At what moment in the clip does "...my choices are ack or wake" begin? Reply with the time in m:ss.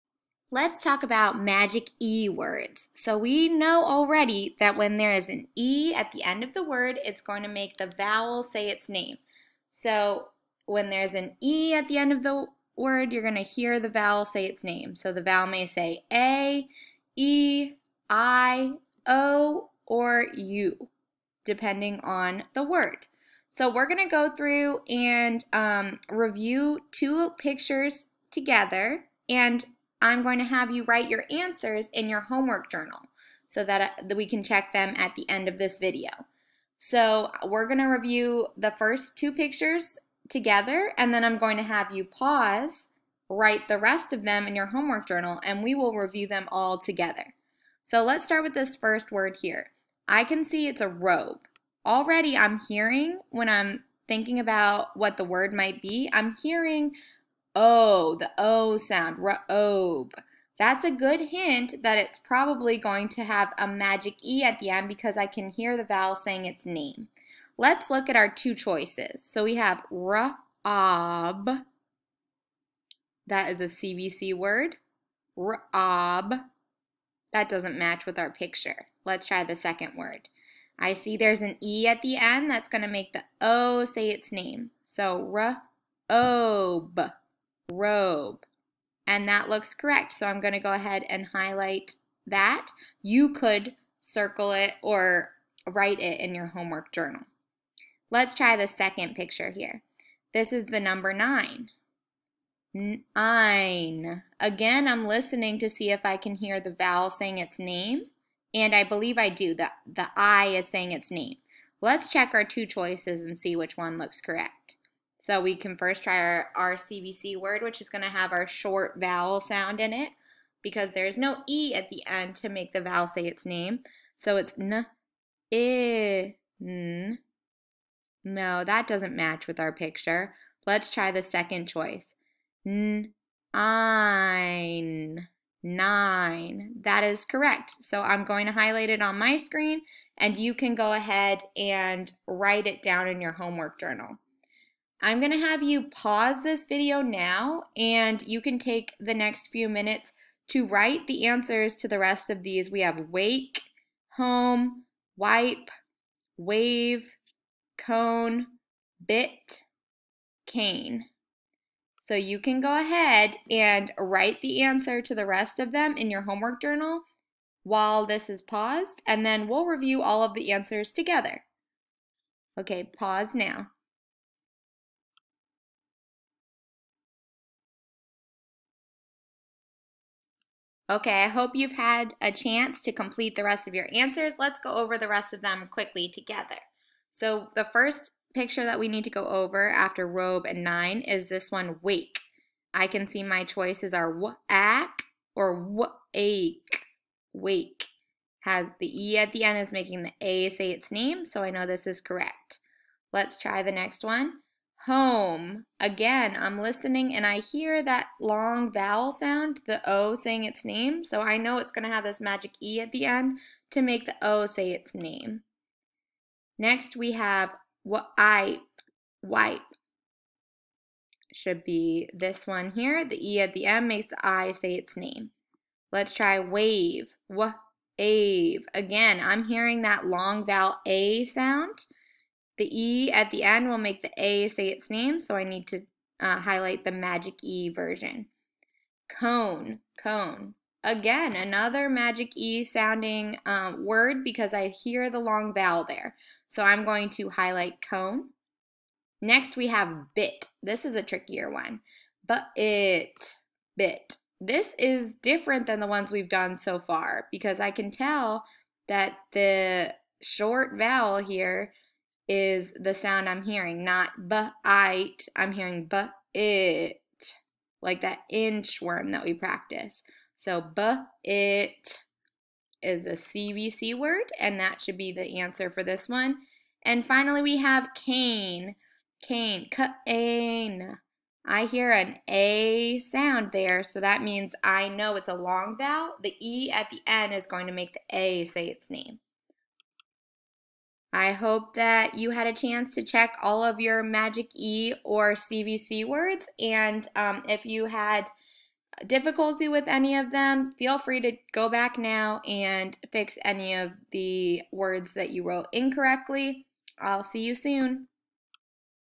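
3:13.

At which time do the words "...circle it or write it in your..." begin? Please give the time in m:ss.
1:34.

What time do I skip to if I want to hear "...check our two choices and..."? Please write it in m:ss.
1:52.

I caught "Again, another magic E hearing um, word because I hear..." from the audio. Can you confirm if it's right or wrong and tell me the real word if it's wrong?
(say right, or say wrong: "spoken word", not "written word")
wrong: "sounding", not "hearing".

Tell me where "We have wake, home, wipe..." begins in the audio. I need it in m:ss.
2:32.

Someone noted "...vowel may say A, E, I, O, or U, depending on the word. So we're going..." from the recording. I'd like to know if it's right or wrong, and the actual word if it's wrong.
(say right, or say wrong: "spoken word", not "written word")
right.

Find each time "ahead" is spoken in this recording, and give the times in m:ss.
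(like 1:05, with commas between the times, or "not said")
1:30, 2:20, 2:42.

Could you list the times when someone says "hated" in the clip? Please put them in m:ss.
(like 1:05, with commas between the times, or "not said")
not said.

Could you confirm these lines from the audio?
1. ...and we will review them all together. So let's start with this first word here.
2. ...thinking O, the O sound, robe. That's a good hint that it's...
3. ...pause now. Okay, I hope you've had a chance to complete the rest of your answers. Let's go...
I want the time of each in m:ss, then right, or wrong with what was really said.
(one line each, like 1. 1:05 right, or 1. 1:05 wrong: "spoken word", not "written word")
1. 0:45 right
2. 0:56 wrong: "hearing", not "thinking"
3. 2:52 right.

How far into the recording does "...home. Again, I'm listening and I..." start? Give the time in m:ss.
3:24.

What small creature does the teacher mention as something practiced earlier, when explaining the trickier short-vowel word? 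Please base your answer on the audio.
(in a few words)
inchworm.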